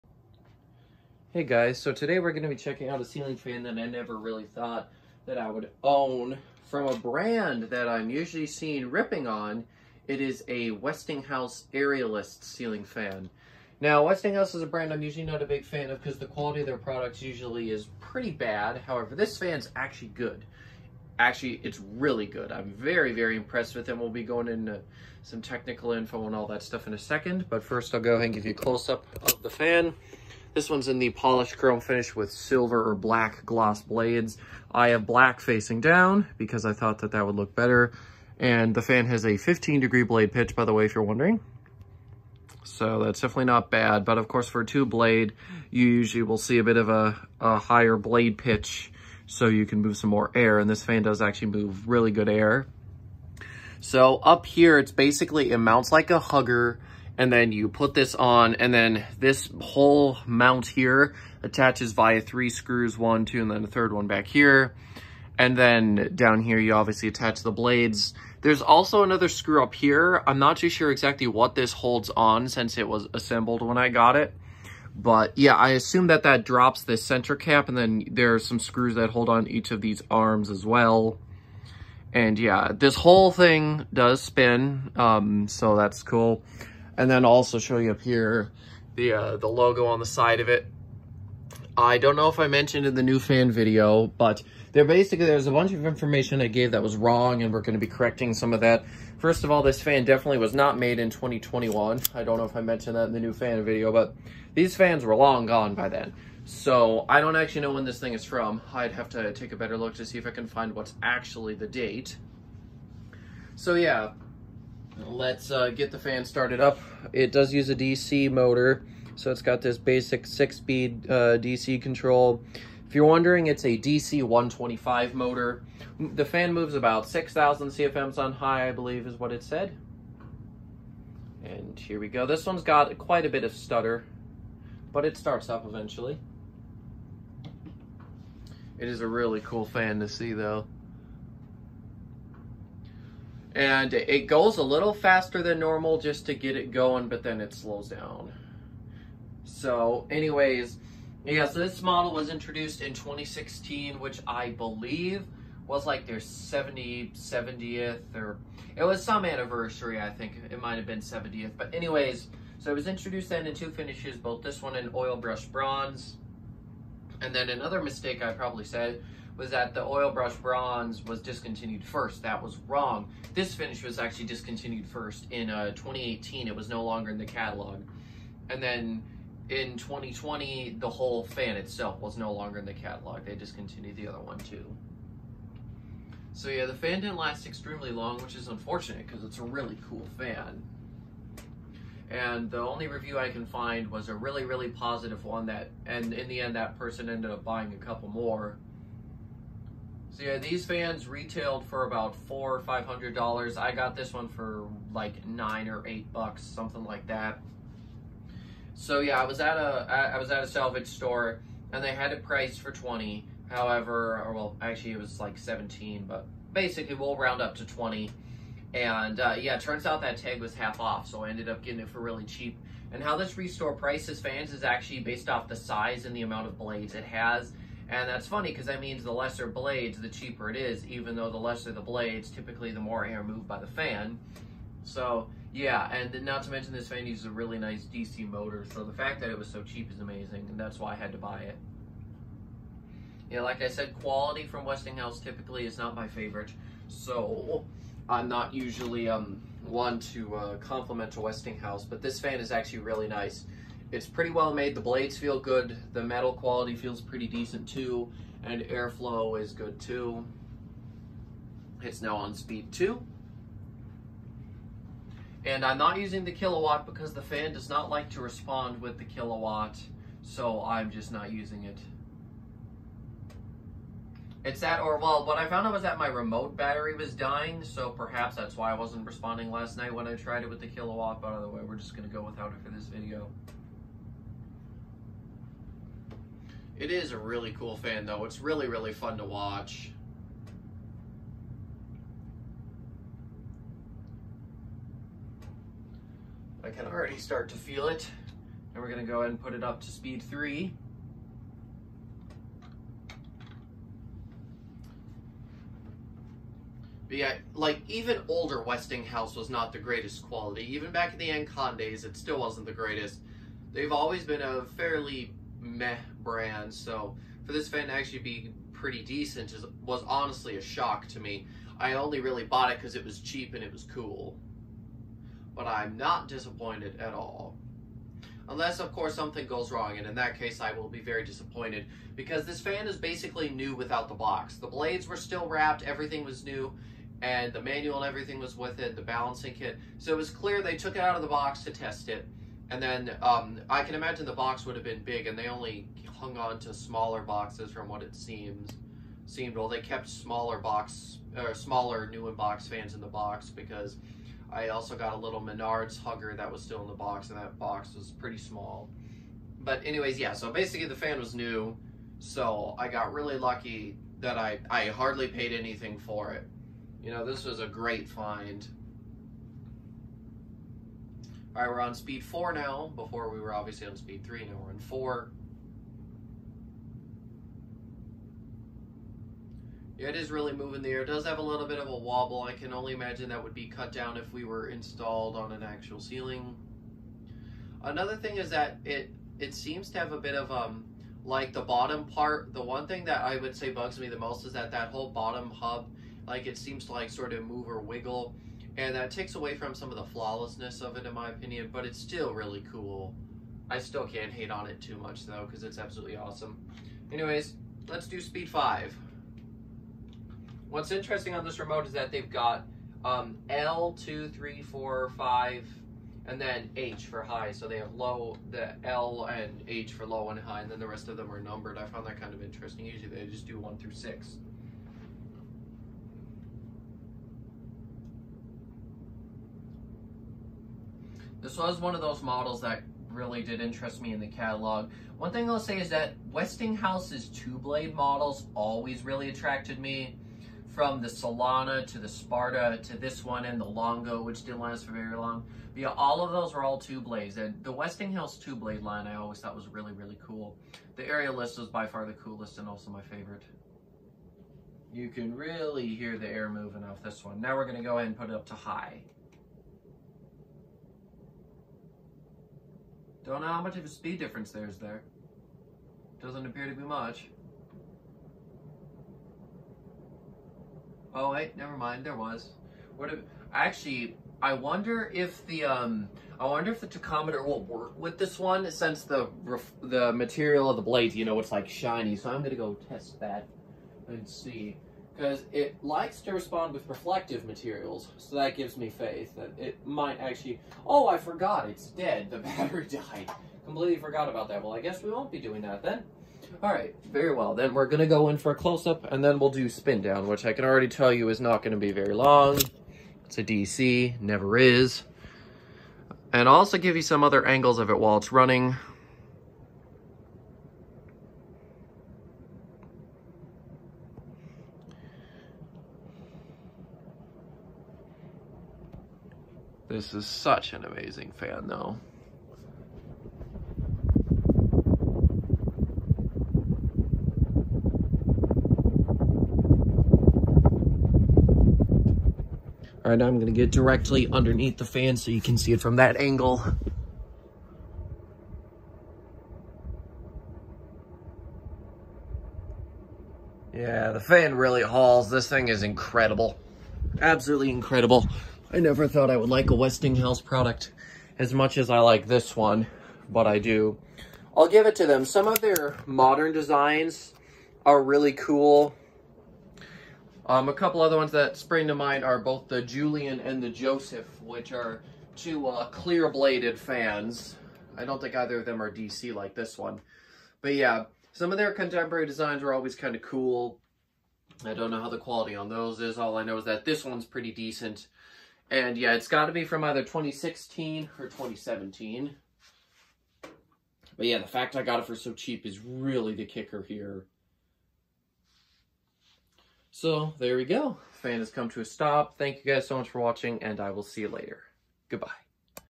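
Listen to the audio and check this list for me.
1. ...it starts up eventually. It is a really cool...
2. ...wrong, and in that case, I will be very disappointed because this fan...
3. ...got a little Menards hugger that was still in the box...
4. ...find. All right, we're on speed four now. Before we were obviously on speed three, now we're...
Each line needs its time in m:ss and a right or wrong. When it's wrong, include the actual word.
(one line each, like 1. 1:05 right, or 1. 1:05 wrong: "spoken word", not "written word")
1. 2:15 right
2. 5:29 right
3. 5:54 right
4. 6:08 right.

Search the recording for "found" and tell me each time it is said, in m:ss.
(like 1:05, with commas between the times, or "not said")
4:35, 7:01.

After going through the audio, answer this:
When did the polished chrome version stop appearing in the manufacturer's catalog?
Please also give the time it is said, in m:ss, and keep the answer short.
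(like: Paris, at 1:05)
2018, at 2:55.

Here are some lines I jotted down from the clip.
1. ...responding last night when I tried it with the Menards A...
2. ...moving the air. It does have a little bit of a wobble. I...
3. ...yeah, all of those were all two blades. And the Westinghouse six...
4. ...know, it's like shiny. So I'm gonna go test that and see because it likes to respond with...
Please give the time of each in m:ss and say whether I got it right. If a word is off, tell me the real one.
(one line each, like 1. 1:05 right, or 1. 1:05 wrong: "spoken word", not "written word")
1. 4:39 wrong: "Kill", not "Menards"
2. 6:20 right
3. 7:25 wrong: "two", not "six"
4. 8:01 right.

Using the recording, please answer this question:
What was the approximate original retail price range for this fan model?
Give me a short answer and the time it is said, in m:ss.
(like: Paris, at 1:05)
$400 to $500, at 3:22.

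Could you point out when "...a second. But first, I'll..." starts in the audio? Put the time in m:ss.
0:26.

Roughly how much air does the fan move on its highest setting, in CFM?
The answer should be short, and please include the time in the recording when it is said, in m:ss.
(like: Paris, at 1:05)
6,000, at 2:07.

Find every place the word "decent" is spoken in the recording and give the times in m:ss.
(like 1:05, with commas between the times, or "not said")
4:17, 5:19, 9:37.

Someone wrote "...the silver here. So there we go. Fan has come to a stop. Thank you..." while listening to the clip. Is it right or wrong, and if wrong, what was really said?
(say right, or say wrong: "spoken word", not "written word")
wrong: "kicker", not "silver".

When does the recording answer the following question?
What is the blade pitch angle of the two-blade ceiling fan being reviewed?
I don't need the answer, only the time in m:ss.
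0:39.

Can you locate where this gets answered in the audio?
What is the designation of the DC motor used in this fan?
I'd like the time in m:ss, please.
2:03.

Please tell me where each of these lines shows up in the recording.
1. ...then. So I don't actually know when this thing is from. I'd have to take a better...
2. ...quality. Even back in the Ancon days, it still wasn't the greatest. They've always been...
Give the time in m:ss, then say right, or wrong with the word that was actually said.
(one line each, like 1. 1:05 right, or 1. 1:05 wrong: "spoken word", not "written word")
1. 1:45 right
2. 5:10 right.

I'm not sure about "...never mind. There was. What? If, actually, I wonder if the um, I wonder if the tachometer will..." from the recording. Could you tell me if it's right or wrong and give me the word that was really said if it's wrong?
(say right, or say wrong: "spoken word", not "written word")
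right.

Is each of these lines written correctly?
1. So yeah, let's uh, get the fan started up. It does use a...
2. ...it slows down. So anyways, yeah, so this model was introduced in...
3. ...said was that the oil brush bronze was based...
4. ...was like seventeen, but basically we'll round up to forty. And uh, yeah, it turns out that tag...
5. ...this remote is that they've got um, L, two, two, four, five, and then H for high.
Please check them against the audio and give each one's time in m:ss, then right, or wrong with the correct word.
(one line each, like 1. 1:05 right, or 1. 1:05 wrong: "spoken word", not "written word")
1. 1:53 right
2. 2:27 right
3. 2:48 wrong: "discontinued", not "based"
4. 3:34 wrong: "twenty", not "forty"
5. 6:51 wrong: "three", not "two".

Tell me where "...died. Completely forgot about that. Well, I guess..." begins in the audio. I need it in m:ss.
8:12.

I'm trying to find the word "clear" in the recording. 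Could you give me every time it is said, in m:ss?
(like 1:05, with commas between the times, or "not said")
5:40, 9:25.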